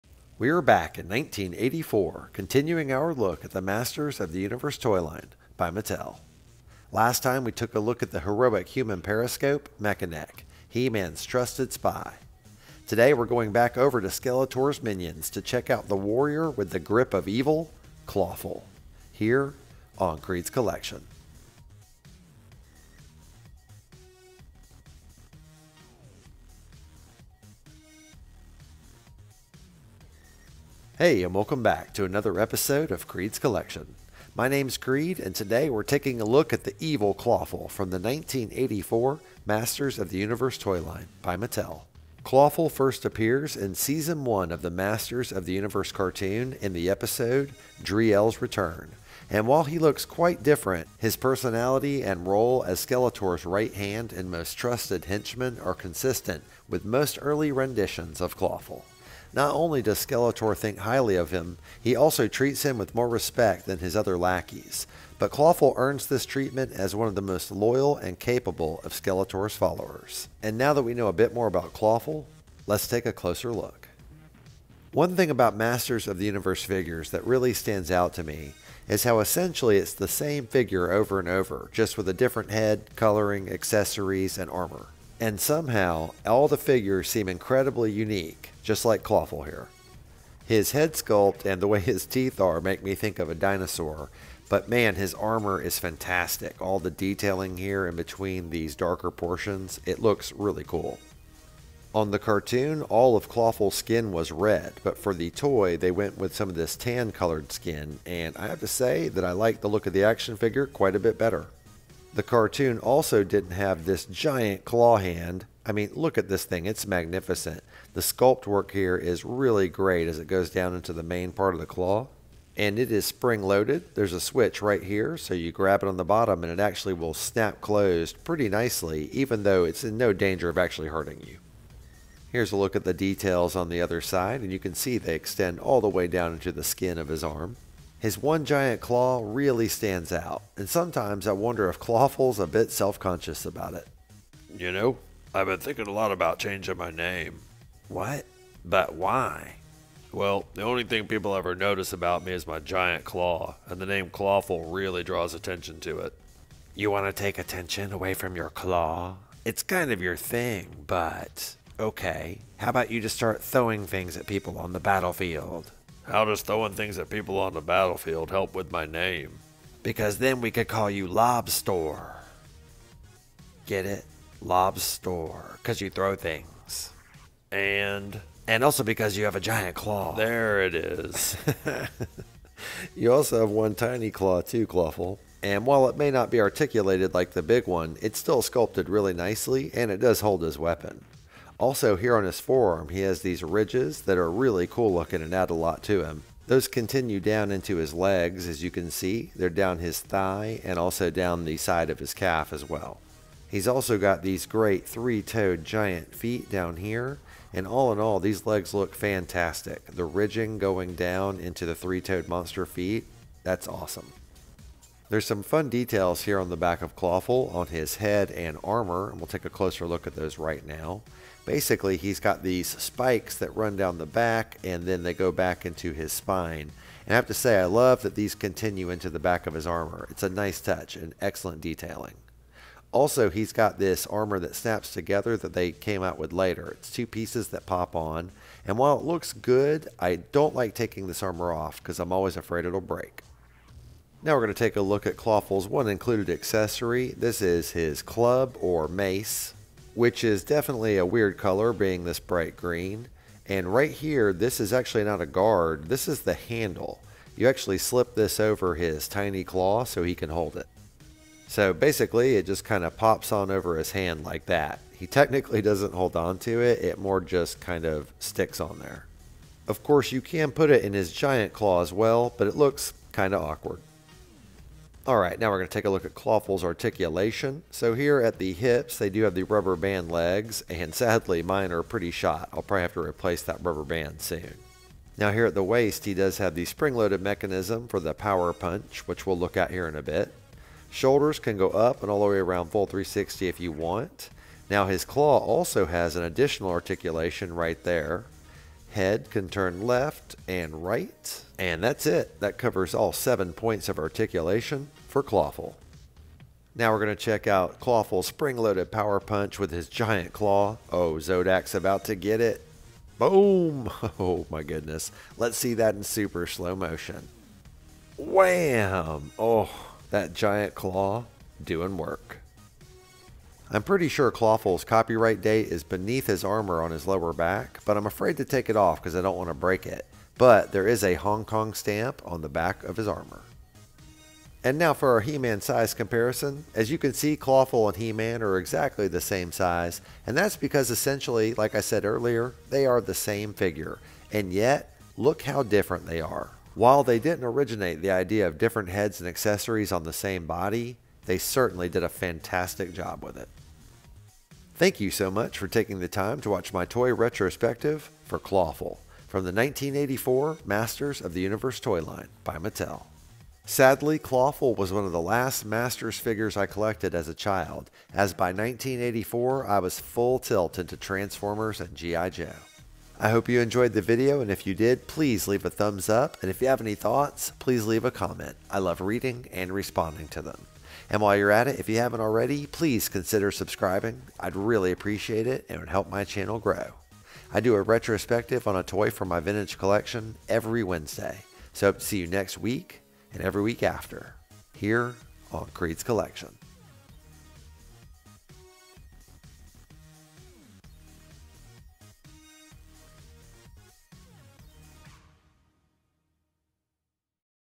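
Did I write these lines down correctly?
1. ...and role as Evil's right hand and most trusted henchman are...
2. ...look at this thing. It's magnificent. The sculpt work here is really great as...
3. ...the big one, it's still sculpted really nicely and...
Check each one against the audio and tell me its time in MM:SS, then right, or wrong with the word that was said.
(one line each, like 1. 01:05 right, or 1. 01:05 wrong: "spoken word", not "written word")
1. 00:52 wrong: "Skeletor", not "Evil"
2. 01:55 right
3. 03:07 right.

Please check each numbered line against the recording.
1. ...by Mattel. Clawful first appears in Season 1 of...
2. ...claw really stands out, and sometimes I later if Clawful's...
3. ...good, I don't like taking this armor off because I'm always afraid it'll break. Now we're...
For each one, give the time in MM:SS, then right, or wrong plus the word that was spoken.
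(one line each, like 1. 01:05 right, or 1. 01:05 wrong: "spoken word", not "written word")
1. 00:41 right
2. 02:18 wrong: "wonder", not "later"
3. 03:59 right.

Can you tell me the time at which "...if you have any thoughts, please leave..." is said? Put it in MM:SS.
06:16.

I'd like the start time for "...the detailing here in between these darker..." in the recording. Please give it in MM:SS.
01:36.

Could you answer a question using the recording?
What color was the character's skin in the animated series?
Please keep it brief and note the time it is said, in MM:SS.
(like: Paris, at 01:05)
Red, at 01:44.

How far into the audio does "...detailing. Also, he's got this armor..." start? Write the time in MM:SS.
03:51.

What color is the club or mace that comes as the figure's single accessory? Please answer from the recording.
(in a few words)
Bright green.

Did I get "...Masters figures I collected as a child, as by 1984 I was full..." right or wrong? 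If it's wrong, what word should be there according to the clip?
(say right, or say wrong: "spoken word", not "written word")
right.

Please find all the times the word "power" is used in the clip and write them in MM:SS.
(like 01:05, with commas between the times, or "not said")
04:48, 05:08.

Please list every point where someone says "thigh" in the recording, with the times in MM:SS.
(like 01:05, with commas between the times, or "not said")
03:19.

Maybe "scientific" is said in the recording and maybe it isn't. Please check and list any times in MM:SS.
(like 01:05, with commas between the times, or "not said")
not said.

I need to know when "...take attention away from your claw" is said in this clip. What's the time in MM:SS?
02:37.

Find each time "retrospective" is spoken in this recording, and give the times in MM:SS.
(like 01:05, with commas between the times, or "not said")
05:57, 06:27.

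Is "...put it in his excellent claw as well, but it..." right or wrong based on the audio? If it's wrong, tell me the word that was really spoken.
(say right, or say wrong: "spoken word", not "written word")
wrong: "giant", not "excellent".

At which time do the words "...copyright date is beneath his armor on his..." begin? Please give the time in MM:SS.
05:24.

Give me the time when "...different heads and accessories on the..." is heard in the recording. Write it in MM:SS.
05:48.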